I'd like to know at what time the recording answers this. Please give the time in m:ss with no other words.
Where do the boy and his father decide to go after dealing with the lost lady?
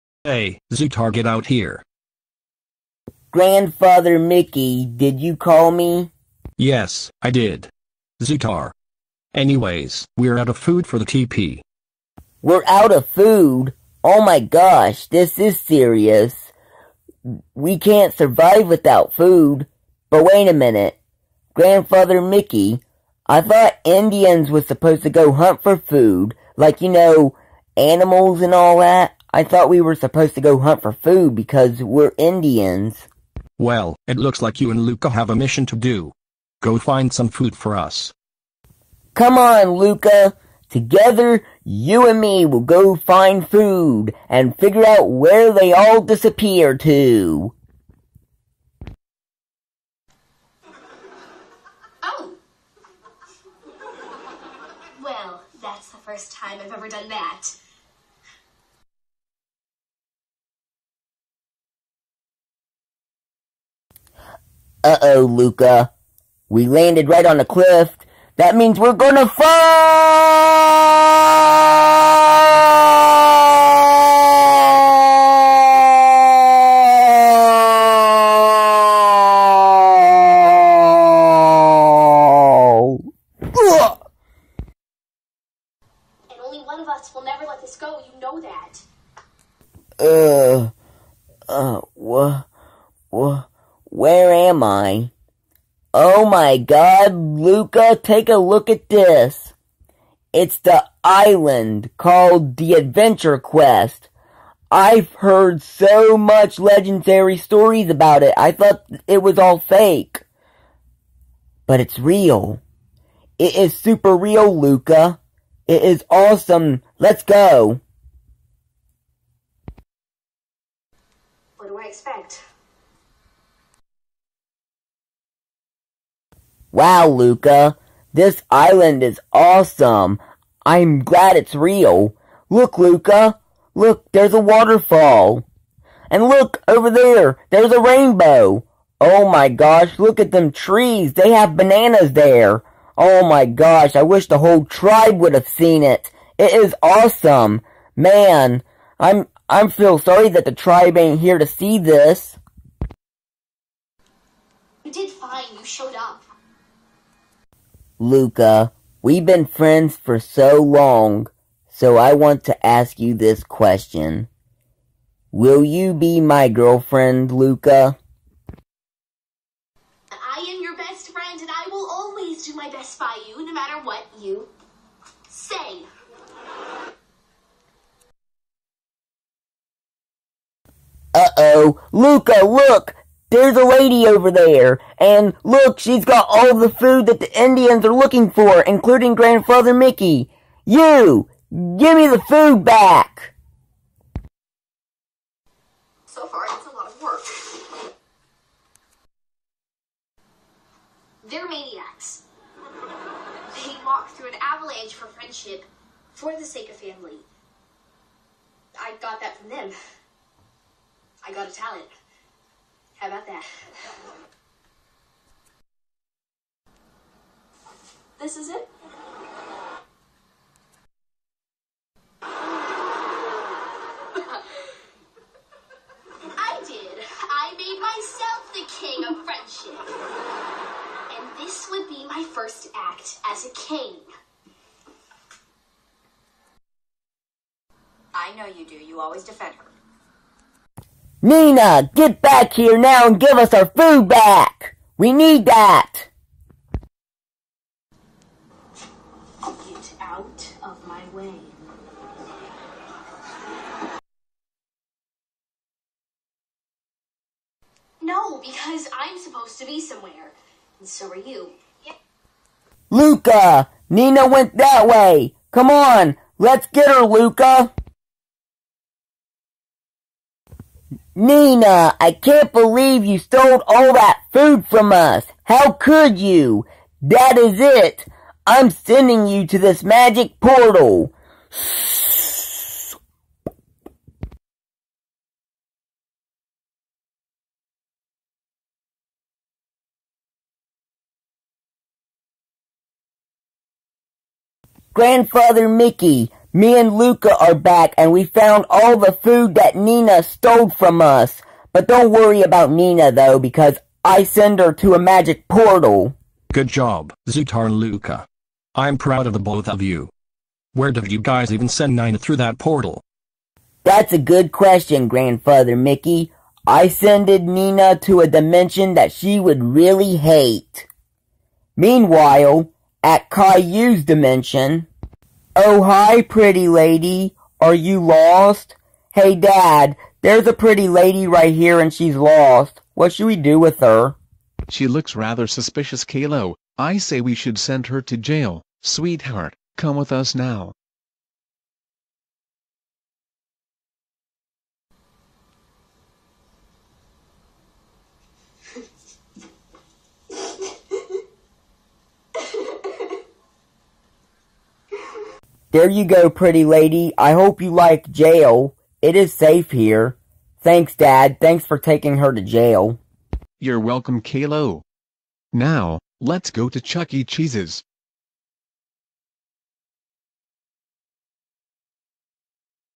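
6:06.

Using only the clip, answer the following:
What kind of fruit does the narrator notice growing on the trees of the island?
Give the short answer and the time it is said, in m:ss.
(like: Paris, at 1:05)
Bananas, at 2:21.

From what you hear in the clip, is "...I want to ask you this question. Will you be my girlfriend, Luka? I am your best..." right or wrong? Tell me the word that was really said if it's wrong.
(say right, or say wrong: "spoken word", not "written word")
right.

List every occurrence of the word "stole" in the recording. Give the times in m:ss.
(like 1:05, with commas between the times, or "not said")
4:33, 5:00.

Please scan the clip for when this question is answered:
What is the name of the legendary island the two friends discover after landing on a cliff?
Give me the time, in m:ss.
1:42.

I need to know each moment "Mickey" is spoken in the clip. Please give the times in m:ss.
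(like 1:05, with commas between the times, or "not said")
0:04, 0:22, 3:09, 4:55, 5:15.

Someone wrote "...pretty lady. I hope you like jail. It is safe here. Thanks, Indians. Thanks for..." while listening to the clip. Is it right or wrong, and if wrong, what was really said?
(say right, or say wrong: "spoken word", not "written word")
wrong: "Dad", not "Indians".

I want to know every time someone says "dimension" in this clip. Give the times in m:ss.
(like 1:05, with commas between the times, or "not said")
5:18, 5:24.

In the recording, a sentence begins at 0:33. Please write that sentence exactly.
Well, it looks like you and Luka have a mission to do.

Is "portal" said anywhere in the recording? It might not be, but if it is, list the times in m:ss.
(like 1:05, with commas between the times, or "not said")
4:40, 5:05, 5:12.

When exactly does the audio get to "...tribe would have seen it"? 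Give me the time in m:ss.
2:24.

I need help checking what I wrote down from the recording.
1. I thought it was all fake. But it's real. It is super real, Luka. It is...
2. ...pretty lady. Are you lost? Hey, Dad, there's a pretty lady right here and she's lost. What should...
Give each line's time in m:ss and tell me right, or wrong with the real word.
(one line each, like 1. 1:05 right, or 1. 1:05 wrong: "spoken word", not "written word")
1. 1:48 right
2. 5:26 right.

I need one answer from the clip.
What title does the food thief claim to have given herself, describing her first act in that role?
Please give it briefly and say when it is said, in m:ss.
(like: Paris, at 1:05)
King of friendship, at 3:48.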